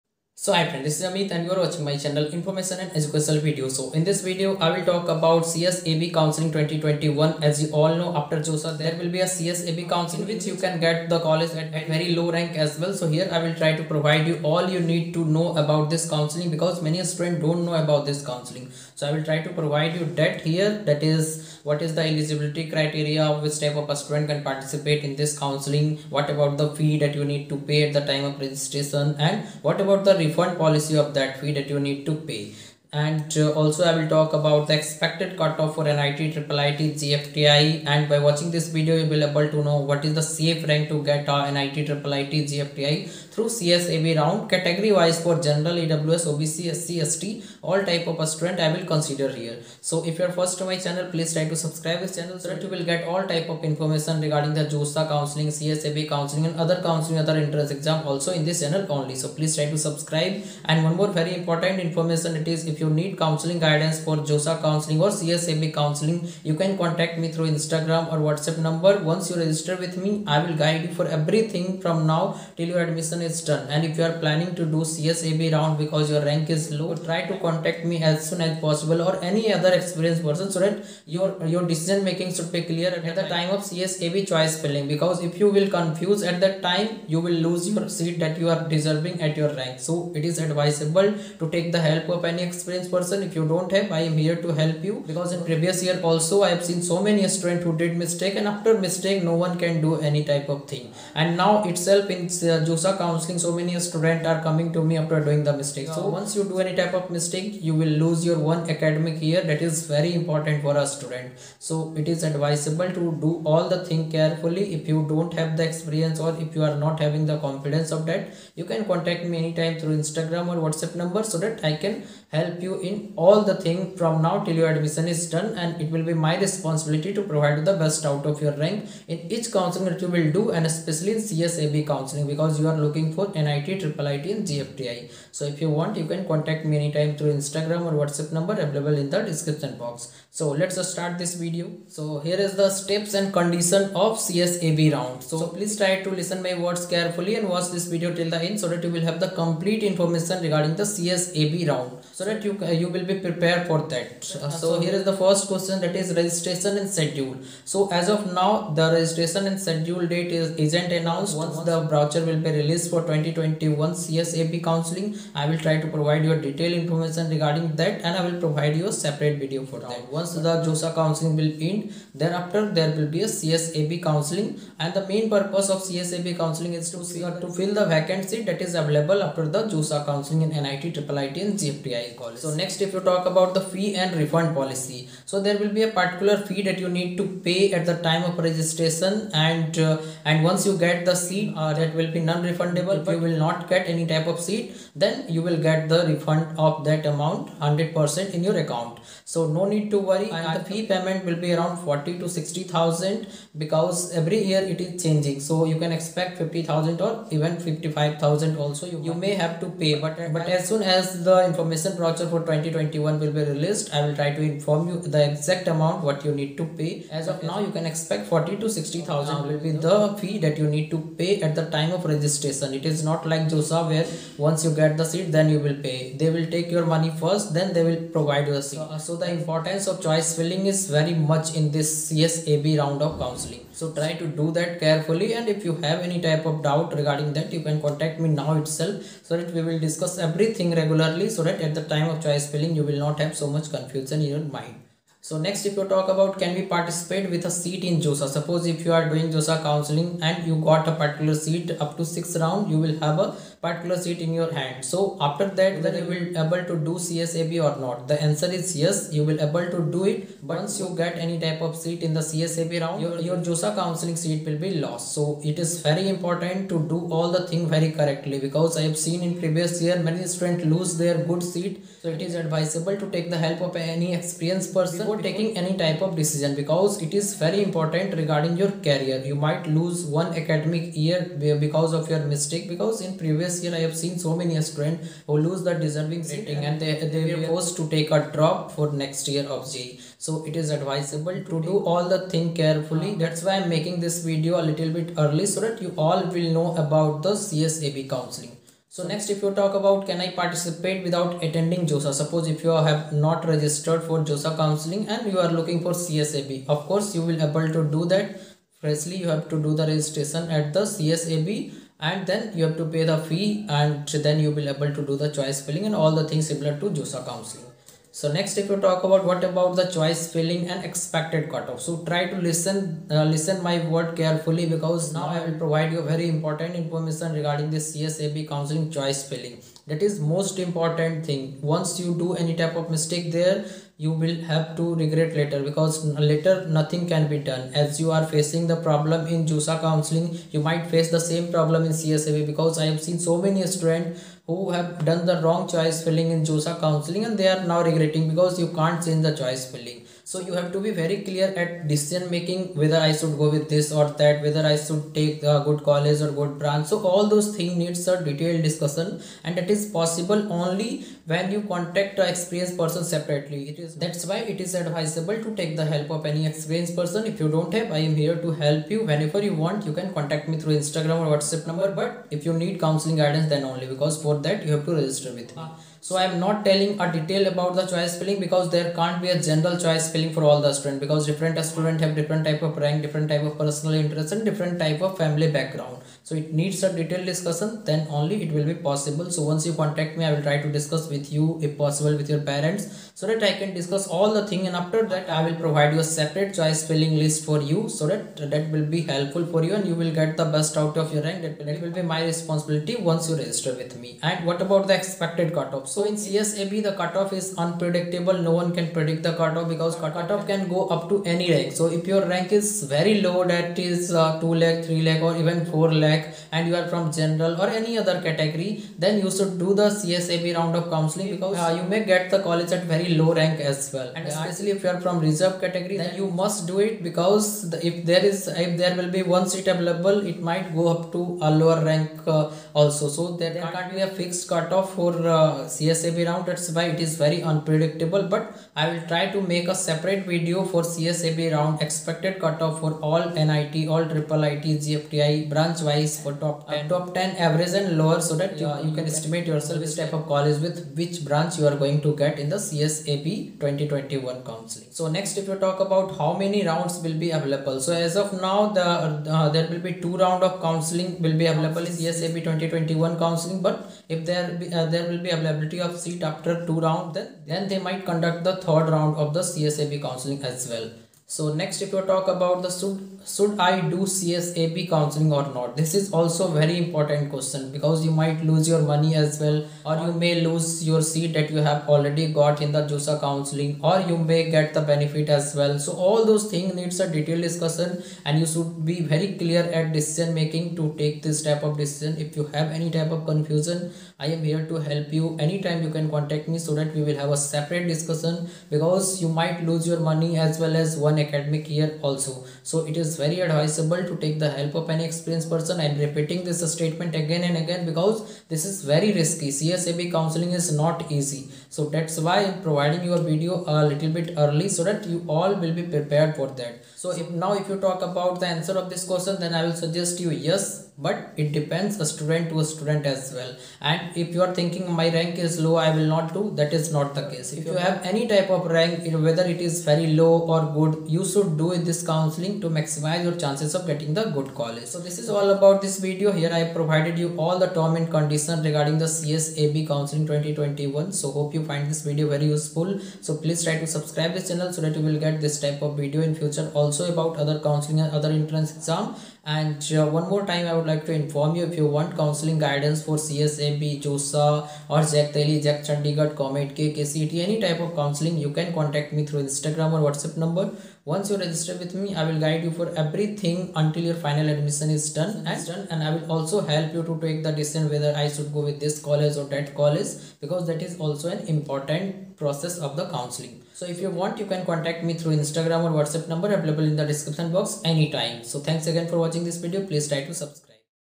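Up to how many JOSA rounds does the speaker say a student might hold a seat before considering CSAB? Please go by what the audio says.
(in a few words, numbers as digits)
Six.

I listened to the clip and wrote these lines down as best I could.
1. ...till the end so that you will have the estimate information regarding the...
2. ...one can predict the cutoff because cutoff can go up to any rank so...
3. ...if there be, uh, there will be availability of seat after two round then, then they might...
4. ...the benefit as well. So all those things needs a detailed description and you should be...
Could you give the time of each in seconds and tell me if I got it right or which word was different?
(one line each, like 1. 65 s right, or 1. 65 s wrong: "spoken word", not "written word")
1. 148 s wrong: "complete", not "estimate"
2. 408 s right
3. 464 s right
4. 484 s wrong: "discussion", not "description".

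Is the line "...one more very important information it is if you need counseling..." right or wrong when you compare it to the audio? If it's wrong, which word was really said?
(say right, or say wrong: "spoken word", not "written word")
right.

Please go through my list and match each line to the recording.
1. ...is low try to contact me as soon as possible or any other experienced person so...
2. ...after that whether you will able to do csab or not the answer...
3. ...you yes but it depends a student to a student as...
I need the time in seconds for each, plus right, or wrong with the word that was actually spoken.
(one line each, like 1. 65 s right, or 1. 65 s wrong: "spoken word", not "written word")
1. 76 s right
2. 255 s right
3. 520 s right.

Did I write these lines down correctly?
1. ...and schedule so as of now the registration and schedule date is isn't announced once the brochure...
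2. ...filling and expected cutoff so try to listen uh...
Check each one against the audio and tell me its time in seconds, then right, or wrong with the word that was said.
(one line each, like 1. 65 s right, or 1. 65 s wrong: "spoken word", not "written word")
1. 156 s right
2. 320 s right.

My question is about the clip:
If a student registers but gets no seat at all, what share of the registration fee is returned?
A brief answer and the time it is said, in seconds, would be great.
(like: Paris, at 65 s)
100%, at 197 s.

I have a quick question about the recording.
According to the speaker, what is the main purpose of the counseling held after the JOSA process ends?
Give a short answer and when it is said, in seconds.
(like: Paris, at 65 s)
To fill the vacancy, at 177 s.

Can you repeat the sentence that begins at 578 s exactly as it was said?
So thanks again for watching this video.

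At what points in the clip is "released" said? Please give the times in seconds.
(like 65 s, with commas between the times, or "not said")
162 s, 213 s.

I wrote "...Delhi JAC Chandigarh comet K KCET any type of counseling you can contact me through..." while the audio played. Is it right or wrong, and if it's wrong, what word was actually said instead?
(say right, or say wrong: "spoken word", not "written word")
right.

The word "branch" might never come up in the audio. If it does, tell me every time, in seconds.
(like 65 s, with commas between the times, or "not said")
356 s, 445 s, 451 s.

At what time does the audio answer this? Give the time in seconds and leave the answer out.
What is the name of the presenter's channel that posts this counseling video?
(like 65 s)
2 s.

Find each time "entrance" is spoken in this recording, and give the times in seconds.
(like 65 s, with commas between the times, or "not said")
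57 s, 548 s.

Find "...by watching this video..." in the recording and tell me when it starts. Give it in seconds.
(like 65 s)
38 s.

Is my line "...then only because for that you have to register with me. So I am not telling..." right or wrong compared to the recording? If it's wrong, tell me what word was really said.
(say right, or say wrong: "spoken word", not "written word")
right.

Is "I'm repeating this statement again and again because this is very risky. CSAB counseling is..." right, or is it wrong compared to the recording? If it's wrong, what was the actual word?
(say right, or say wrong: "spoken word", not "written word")
right.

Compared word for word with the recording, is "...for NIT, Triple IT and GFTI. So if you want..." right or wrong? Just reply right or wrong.
right.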